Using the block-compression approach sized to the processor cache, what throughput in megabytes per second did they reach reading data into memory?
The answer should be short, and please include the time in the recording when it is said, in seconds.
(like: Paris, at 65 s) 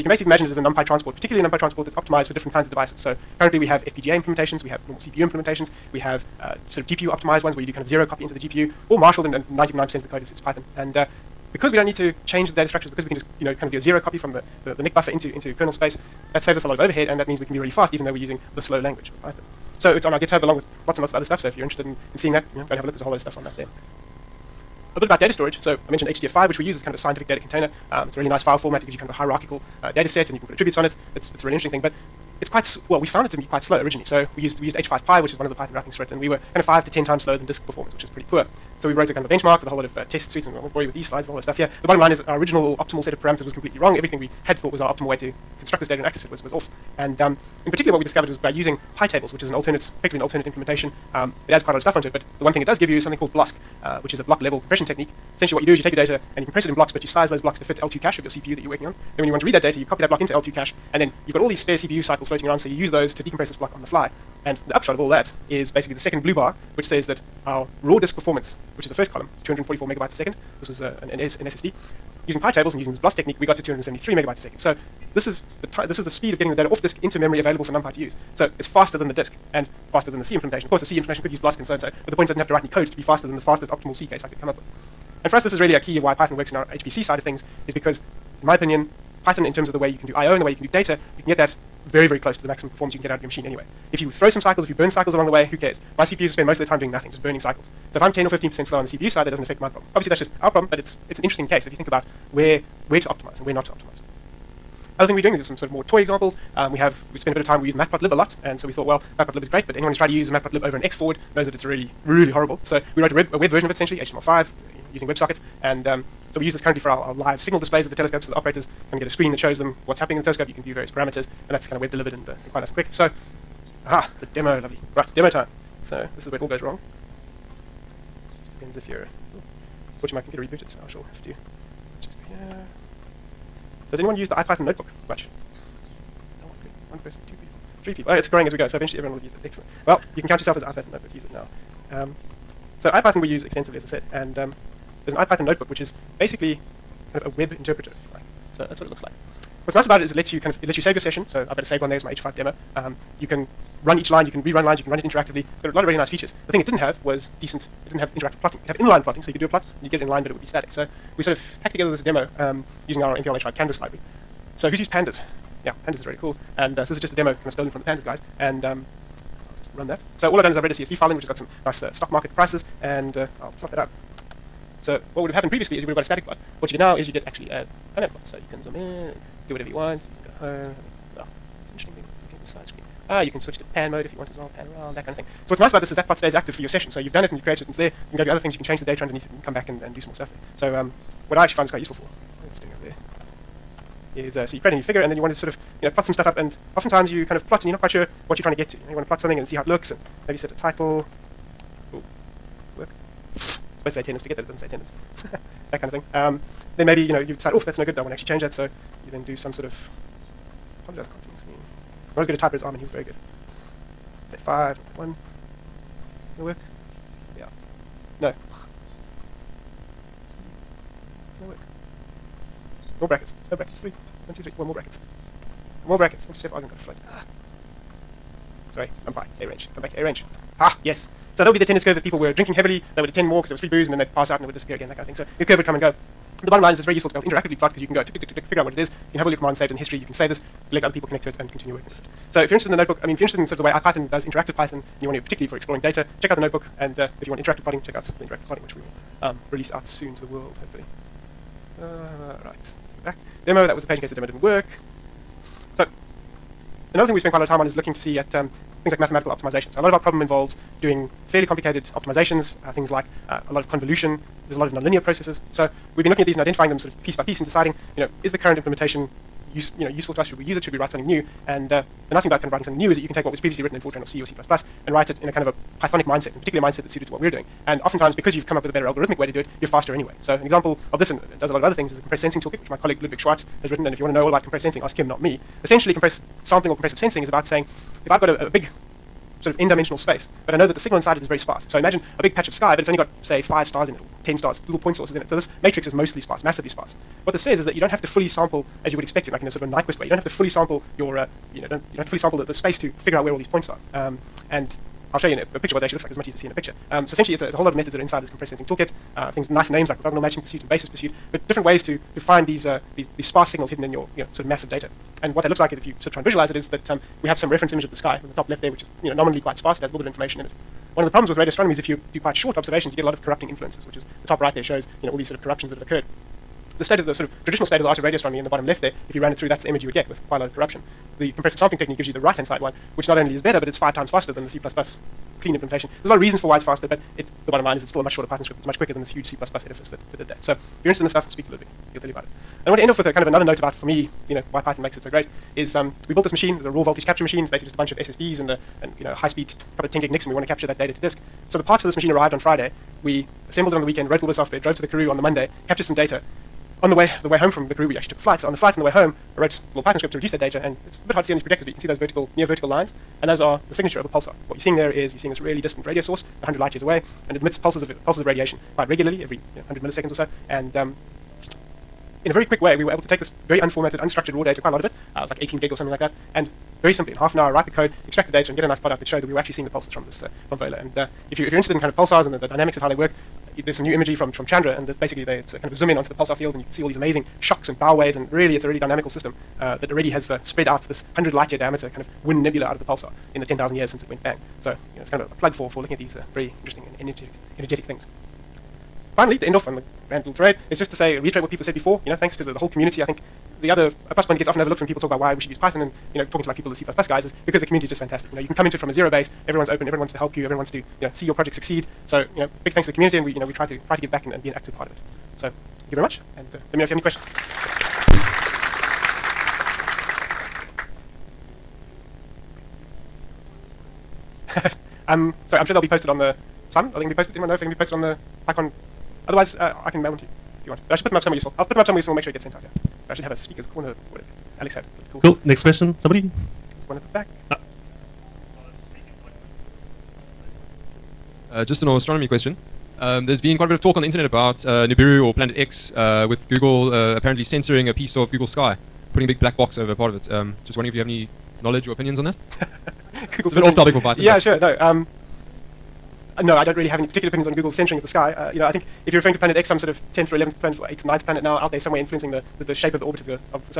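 273, at 73 s.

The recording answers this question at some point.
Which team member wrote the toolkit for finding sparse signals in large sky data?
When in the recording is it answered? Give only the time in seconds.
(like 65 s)
283 s.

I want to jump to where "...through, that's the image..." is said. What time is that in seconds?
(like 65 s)
329 s.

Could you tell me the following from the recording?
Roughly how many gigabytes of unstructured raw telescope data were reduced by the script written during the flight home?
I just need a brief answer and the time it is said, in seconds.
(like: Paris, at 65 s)
18, at 375 s.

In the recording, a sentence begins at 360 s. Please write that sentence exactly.
And it's a bit hard to see on these projectors, but you can see those vertical, near vertical lines.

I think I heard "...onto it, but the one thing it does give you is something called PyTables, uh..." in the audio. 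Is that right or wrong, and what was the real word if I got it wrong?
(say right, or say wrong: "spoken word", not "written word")
wrong: "BLOSC", not "PyTables".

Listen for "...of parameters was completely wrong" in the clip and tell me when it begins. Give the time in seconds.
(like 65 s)
43 s.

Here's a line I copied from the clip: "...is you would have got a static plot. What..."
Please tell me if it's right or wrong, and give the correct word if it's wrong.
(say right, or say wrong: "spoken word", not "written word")
right.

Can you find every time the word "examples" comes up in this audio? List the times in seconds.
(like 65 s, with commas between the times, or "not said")
105 s, 280 s.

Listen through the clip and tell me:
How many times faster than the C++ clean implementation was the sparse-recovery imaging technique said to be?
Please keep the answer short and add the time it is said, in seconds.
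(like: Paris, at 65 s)
5, at 333 s.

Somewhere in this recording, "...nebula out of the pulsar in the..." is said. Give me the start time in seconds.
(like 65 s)
392 s.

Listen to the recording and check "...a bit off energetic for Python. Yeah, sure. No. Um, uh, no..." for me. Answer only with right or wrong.
wrong.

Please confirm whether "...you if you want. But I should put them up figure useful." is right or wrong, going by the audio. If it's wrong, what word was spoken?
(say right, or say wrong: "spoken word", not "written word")
wrong: "somewhere", not "figure".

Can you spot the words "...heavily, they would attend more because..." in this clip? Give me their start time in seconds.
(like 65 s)
232 s.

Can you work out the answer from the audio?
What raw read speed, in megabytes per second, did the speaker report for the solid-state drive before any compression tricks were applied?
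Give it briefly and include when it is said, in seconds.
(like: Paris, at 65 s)
244, at 69 s.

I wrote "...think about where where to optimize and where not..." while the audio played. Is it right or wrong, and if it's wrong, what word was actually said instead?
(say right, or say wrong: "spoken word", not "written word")
right.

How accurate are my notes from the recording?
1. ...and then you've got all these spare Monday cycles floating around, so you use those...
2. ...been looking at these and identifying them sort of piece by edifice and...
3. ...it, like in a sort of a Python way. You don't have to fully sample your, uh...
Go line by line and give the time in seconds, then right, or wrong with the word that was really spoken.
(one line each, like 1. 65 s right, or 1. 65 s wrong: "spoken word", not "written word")
1. 60 s wrong: "CPU", not "Monday"
2. 266 s wrong: "piece", not "edifice"
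3. 299 s wrong: "Nyquist", not "Python".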